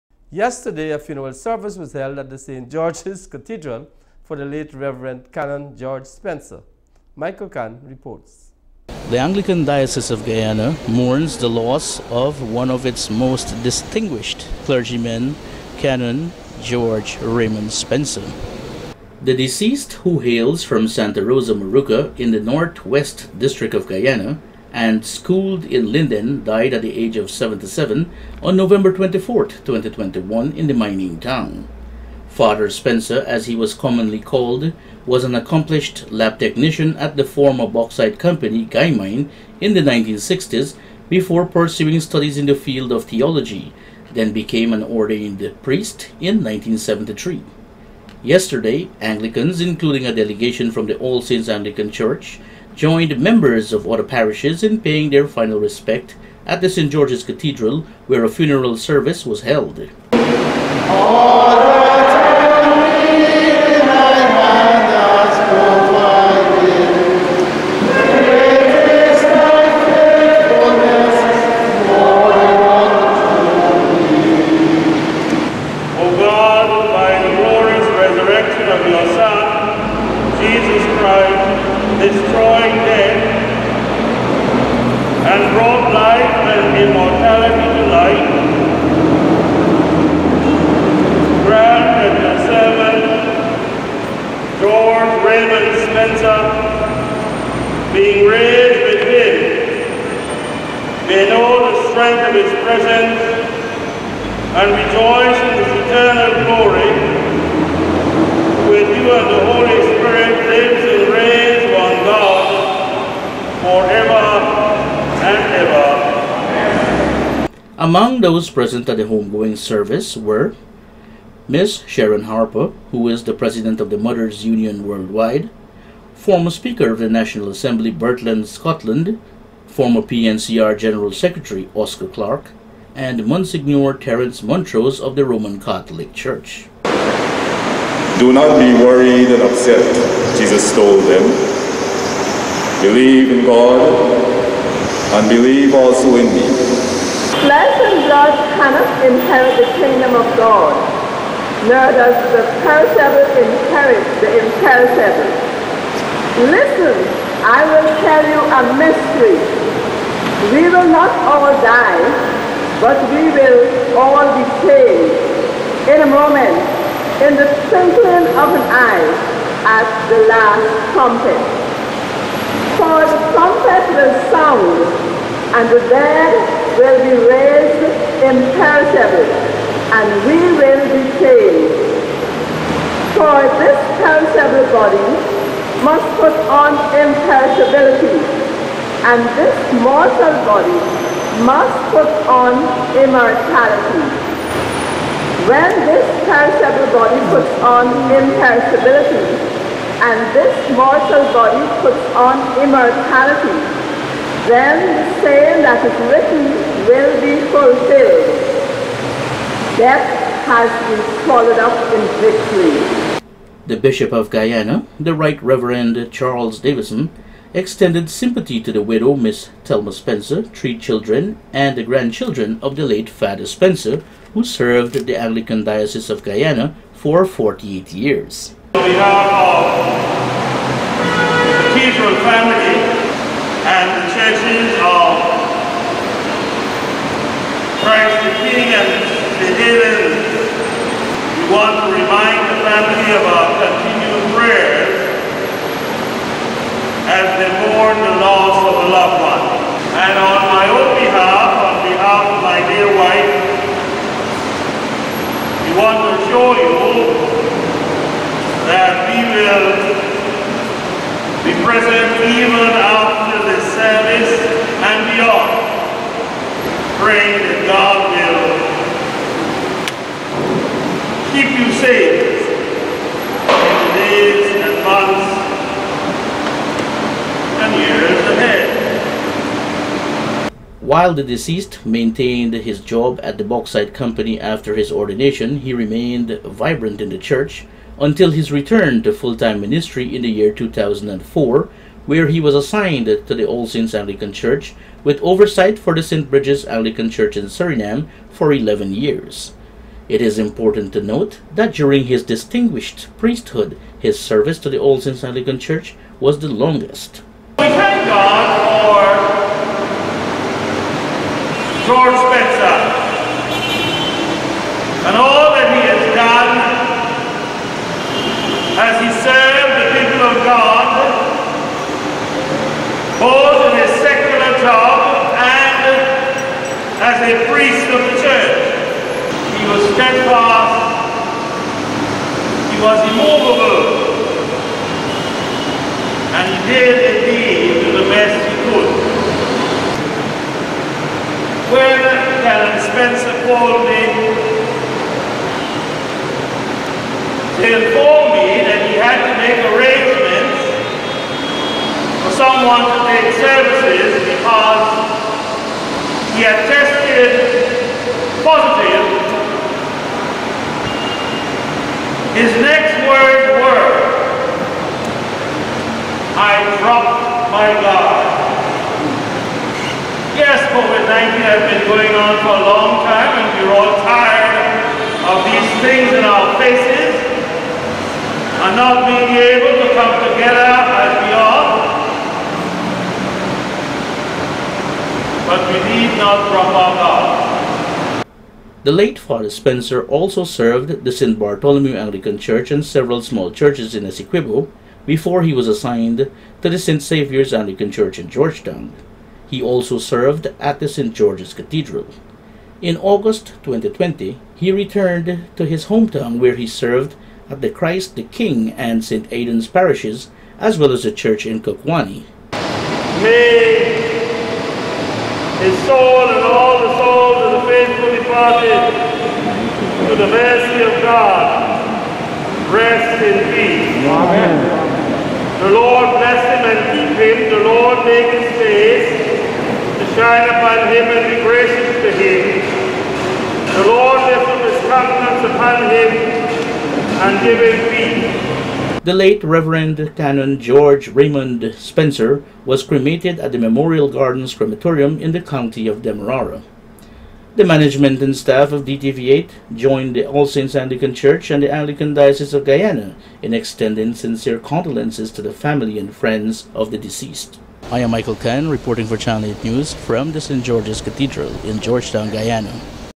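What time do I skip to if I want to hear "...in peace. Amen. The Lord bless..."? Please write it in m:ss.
7:03.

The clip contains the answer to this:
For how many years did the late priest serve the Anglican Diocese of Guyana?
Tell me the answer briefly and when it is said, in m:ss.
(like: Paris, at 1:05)
48, at 3:47.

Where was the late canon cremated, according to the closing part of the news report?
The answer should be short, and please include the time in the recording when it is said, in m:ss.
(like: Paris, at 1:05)
Memorial Gardens Crematorium, at 7:23.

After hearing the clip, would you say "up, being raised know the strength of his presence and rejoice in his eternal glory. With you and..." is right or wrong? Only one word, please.
right.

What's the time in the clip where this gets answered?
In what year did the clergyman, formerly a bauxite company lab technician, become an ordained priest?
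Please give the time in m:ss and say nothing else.
0:46.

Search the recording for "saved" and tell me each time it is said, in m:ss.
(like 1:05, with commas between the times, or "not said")
2:44, 3:01.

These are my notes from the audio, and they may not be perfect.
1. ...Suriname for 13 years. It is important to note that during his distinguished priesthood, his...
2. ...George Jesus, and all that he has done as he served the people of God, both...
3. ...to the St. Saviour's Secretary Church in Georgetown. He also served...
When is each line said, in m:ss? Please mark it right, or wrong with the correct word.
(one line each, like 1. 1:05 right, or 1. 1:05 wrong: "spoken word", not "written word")
1. 4:57 wrong: "11", not "13"
2. 5:11 wrong: "Spencer", not "Jesus"
3. 6:36 wrong: "Anglican", not "Secretary".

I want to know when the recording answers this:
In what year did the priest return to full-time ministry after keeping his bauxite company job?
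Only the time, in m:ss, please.
4:50.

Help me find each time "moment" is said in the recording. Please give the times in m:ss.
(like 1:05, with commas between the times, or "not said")
2:46.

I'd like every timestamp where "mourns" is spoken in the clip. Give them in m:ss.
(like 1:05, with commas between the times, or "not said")
0:10, 4:07.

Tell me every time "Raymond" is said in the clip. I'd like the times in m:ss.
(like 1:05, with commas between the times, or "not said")
0:17, 7:21.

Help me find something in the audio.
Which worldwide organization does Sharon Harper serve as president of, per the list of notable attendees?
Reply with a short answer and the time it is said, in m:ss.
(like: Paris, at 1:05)
Mothers Union, at 2:03.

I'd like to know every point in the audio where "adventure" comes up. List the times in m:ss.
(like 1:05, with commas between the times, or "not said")
not said.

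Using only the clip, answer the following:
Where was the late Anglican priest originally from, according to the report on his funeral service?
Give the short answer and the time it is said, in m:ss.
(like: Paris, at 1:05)
Santa Rosa Moruca, at 0:20.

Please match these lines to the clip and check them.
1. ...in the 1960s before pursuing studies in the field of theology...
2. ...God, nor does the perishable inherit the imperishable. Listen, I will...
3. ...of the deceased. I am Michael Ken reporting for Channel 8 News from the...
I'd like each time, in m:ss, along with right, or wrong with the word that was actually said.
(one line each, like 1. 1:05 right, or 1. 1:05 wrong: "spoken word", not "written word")
1. 0:39 right
2. 2:30 right
3. 7:36 right.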